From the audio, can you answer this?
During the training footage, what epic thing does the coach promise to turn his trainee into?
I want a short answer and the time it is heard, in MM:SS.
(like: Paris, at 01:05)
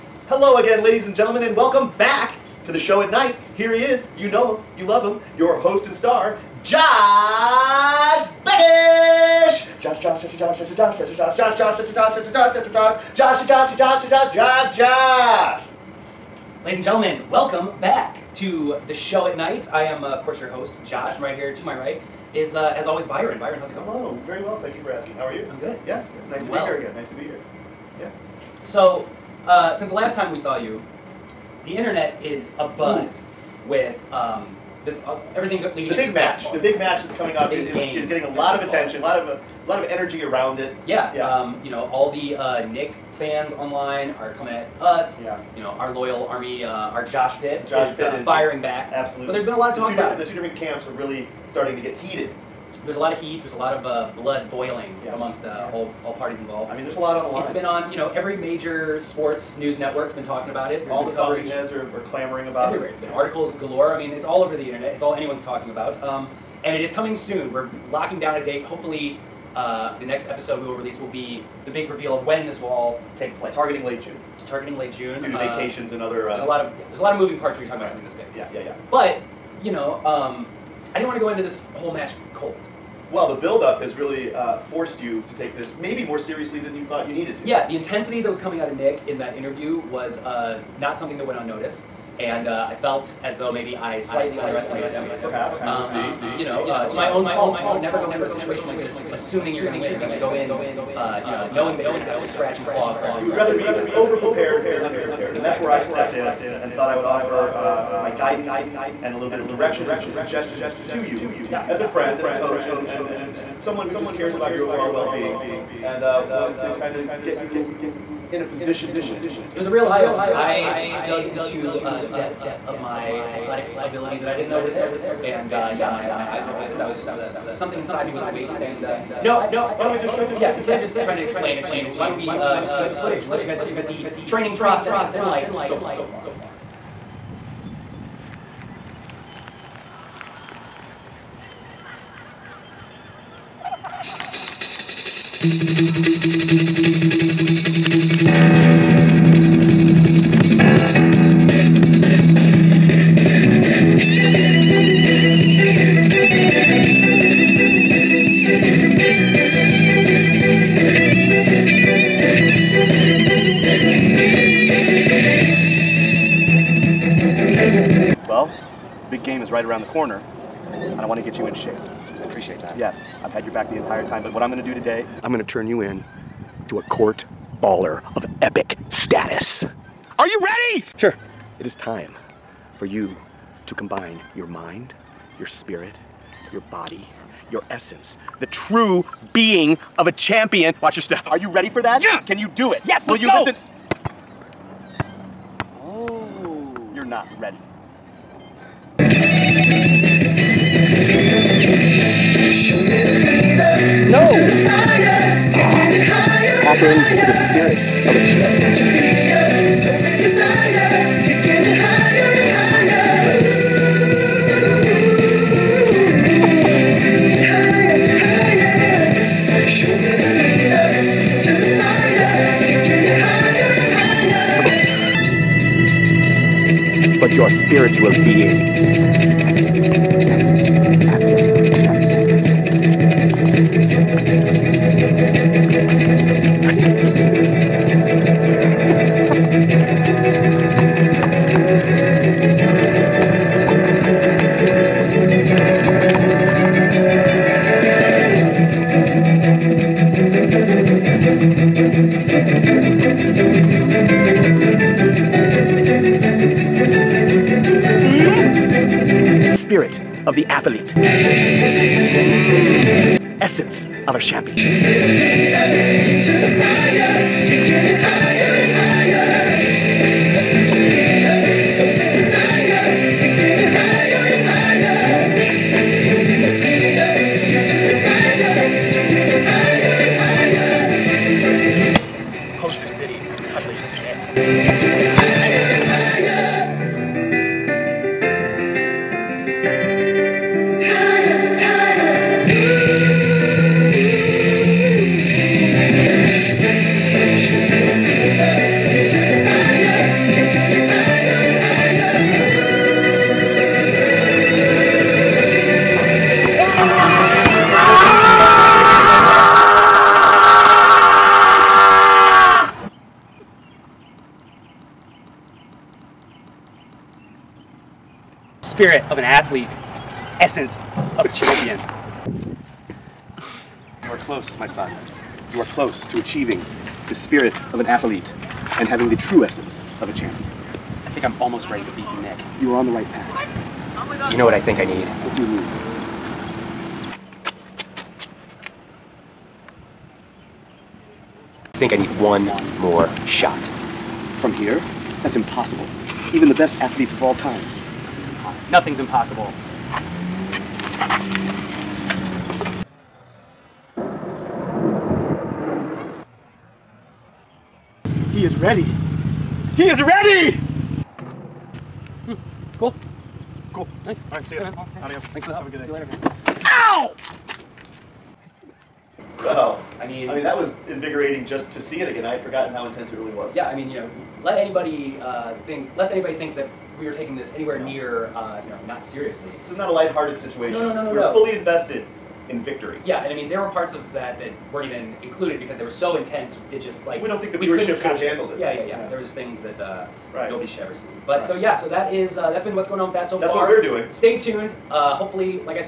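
A court baller, at 02:56.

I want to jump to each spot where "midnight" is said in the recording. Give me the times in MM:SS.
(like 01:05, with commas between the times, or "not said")
not said.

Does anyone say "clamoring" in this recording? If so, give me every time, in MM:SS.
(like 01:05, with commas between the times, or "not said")
01:02.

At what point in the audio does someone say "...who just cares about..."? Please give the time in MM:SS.
01:53.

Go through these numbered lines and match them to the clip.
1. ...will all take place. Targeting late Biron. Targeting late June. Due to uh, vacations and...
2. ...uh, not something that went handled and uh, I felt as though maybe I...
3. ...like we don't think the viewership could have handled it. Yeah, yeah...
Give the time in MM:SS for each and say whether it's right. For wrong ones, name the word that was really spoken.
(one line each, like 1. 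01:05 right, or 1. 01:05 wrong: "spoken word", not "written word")
1. 01:12 wrong: "June", not "Biron"
2. 01:30 wrong: "unnoticed", not "handled"
3. 06:27 right.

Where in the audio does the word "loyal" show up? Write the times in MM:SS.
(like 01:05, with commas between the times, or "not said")
00:45.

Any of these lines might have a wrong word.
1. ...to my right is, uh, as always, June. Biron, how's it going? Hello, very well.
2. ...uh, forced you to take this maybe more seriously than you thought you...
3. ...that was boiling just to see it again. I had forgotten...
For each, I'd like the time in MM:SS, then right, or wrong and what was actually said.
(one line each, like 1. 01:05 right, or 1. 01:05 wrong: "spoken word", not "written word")
1. 00:21 wrong: "Biron", not "June"
2. 01:24 right
3. 06:10 wrong: "invigorating", not "boiling".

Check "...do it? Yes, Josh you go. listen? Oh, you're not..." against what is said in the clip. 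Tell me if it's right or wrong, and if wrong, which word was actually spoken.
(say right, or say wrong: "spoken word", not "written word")
wrong: "Will", not "Josh".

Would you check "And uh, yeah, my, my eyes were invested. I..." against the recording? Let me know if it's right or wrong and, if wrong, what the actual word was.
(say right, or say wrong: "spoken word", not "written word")
wrong: "opened", not "invested".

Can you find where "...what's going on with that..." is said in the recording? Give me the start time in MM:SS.
06:32.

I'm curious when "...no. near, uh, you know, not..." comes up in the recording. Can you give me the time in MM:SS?
06:17.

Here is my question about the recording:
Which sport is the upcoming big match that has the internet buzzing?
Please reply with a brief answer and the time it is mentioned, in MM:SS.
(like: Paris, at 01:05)
Basketball, at 00:36.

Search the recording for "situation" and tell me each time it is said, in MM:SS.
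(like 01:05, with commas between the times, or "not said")
01:38, 06:20.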